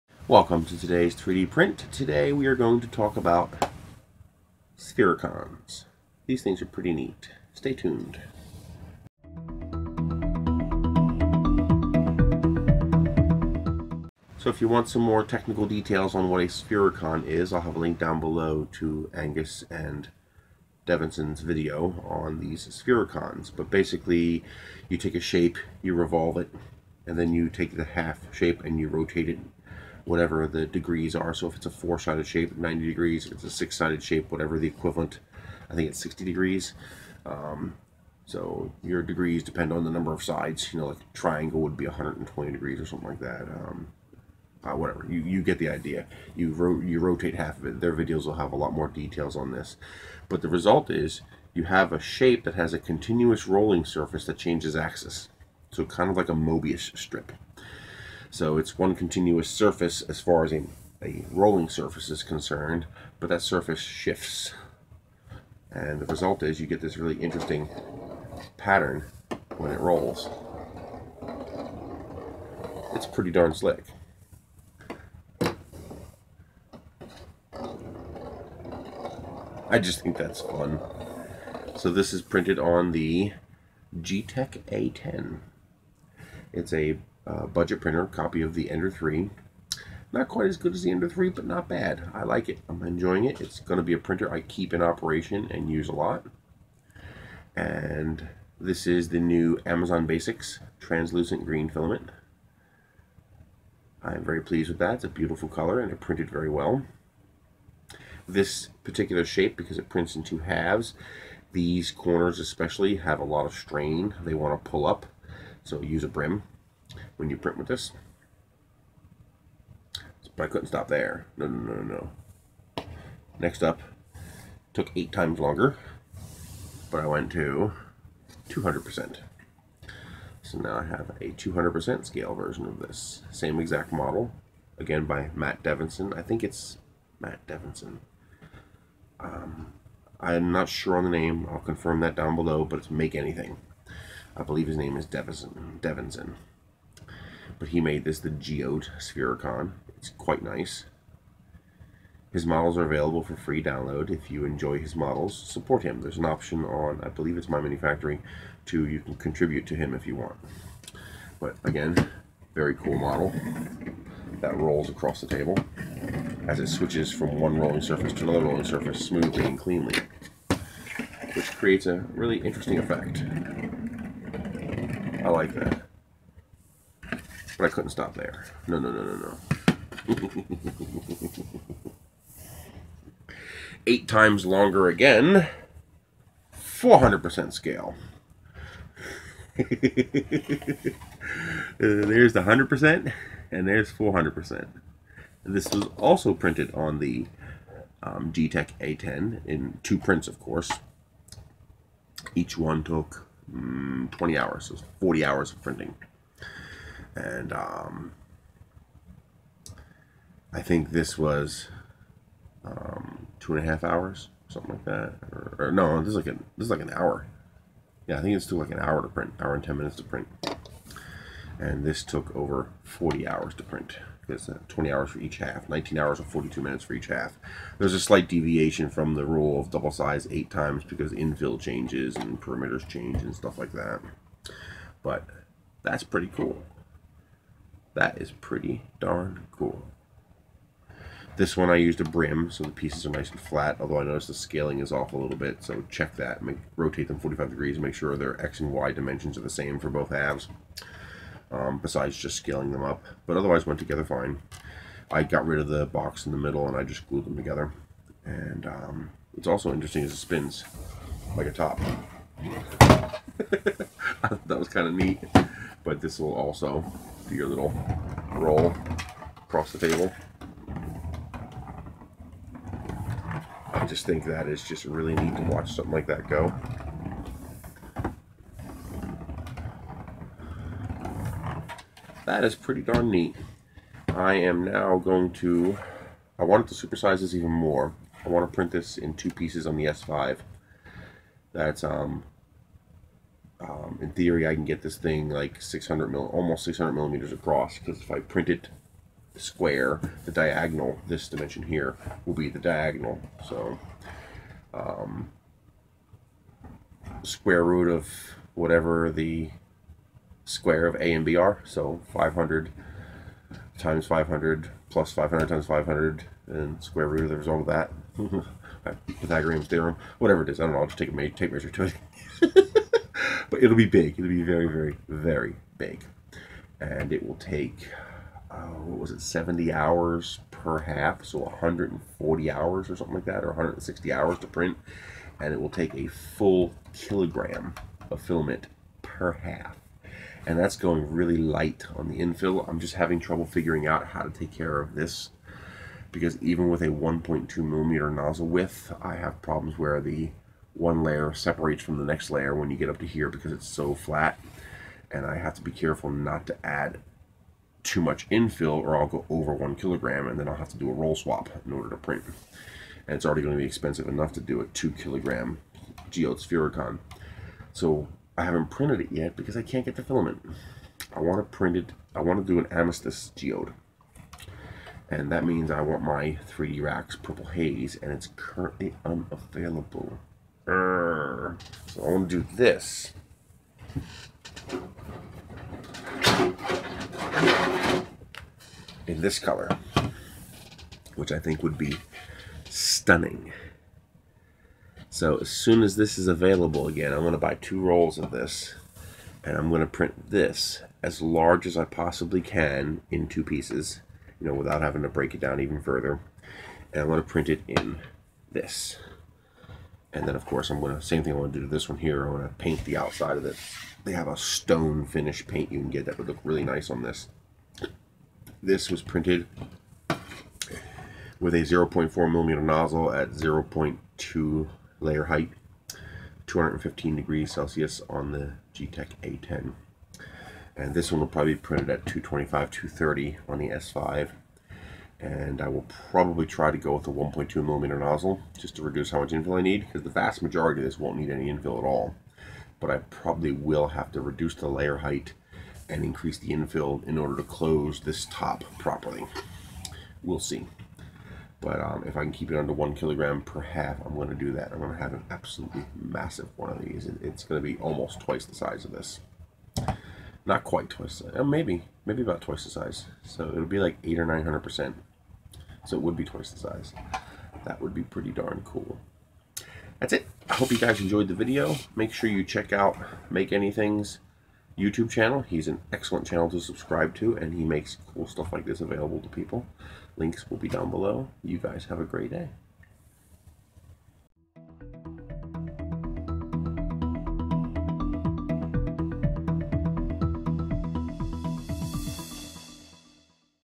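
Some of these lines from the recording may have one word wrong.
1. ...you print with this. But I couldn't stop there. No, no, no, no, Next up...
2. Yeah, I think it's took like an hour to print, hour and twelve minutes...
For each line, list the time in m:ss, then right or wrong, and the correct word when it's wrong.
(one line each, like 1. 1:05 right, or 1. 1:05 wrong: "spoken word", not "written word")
1. 1:57 right
2. 3:38 wrong: "ten", not "twelve".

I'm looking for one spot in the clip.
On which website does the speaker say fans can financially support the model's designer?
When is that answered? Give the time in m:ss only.
2:37.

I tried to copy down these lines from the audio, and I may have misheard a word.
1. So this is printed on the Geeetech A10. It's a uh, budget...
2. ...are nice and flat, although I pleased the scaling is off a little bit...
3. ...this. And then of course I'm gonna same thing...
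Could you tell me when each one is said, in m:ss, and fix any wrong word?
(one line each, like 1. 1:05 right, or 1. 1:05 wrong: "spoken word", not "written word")
1. 1:21 right
2. 4:03 wrong: "noticed", not "pleased"
3. 6:48 right.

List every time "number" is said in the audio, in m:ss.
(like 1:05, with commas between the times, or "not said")
0:39.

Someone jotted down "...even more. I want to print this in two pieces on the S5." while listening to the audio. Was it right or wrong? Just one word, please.
right.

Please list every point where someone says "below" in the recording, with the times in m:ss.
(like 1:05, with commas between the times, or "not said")
0:18, 2:22, 8:00.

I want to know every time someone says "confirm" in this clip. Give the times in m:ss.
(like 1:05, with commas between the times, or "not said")
2:21.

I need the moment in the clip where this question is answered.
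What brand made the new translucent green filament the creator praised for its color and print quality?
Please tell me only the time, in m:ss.
1:39.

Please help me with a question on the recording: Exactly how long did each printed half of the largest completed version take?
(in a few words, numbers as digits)
19 hours and 42 minutes.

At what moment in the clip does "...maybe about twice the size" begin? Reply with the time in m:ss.
7:42.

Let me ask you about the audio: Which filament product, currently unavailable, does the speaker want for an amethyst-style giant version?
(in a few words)
3D Racks Purple Haze.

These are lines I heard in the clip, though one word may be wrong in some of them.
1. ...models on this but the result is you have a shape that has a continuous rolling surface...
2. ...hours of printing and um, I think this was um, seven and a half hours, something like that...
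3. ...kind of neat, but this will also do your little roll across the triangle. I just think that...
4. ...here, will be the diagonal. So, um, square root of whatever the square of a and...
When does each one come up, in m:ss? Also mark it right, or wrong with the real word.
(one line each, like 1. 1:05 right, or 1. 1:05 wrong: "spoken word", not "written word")
1. 0:48 wrong: "details", not "models"
2. 3:25 wrong: "two", not "seven"
3. 4:24 wrong: "table", not "triangle"
4. 5:01 right.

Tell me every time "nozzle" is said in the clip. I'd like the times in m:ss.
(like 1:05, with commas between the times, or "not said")
5:48, 7:02, 7:17.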